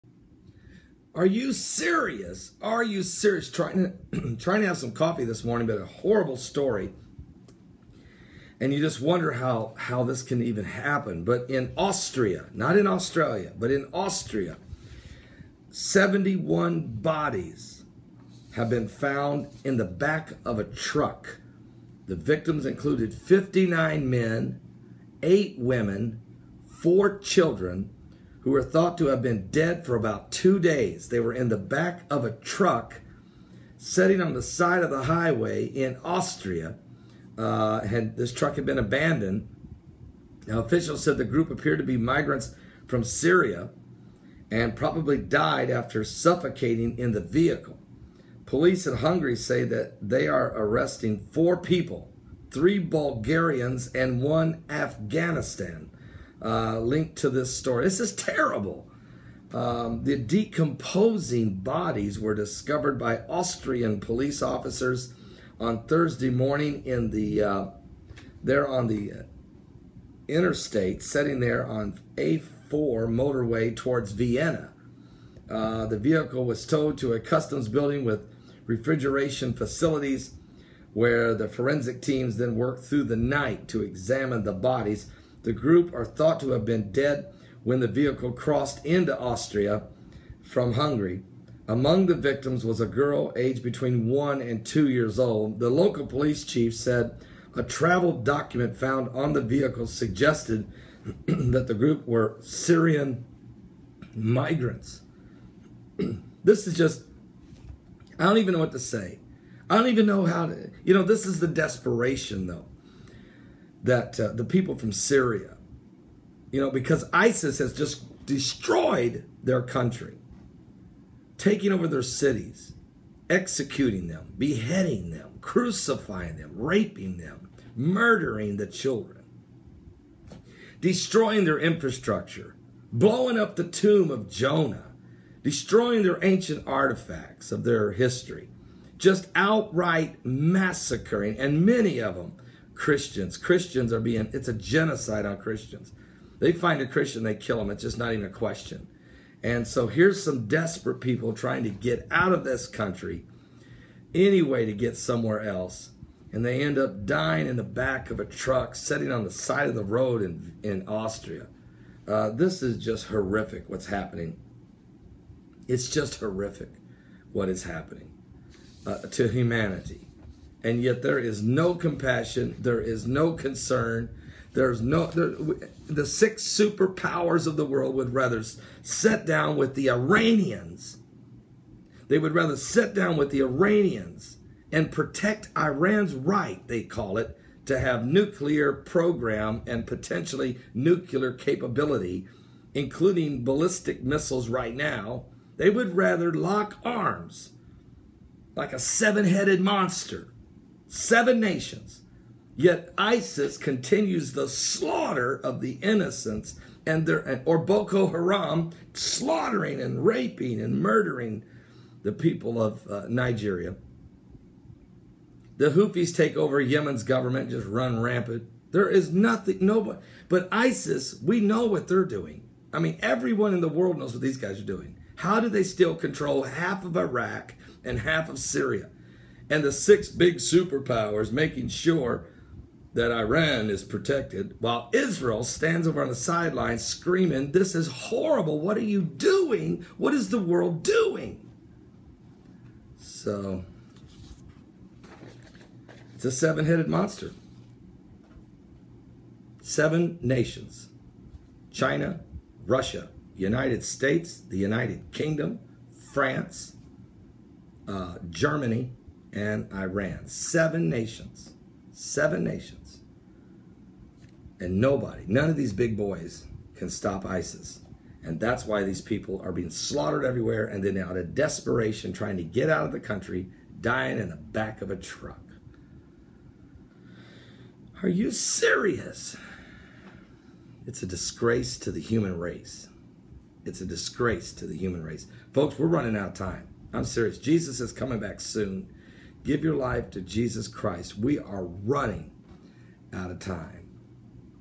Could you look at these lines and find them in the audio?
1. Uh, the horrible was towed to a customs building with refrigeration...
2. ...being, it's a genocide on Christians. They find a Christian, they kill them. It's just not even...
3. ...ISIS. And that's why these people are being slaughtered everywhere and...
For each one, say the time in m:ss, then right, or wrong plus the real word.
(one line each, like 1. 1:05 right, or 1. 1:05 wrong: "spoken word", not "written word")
1. 1:15 wrong: "vehicle", not "horrible"
2. 2:23 right
3. 4:27 right.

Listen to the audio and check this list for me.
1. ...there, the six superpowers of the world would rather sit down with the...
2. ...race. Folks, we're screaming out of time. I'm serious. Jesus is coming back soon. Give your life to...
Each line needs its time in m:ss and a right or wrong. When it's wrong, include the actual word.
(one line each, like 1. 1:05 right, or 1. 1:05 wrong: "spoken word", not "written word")
1. 2:55 right
2. 4:45 wrong: "running", not "screaming".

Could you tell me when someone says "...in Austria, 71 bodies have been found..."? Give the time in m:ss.
0:13.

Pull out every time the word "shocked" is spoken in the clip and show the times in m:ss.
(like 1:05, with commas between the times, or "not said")
not said.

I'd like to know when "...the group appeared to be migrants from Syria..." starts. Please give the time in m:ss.
0:41.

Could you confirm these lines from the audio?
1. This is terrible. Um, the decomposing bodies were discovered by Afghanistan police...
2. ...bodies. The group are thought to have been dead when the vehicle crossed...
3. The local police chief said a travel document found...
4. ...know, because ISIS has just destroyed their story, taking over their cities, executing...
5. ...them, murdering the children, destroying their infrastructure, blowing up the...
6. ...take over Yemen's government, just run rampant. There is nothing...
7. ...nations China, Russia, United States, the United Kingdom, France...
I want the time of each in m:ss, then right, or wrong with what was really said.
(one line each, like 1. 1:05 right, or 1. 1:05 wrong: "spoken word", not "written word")
1. 0:57 wrong: "Austrian", not "Afghanistan"
2. 1:24 right
3. 1:35 right
4. 1:56 wrong: "country", not "story"
5. 2:07 right
6. 3:36 right
7. 4:10 right.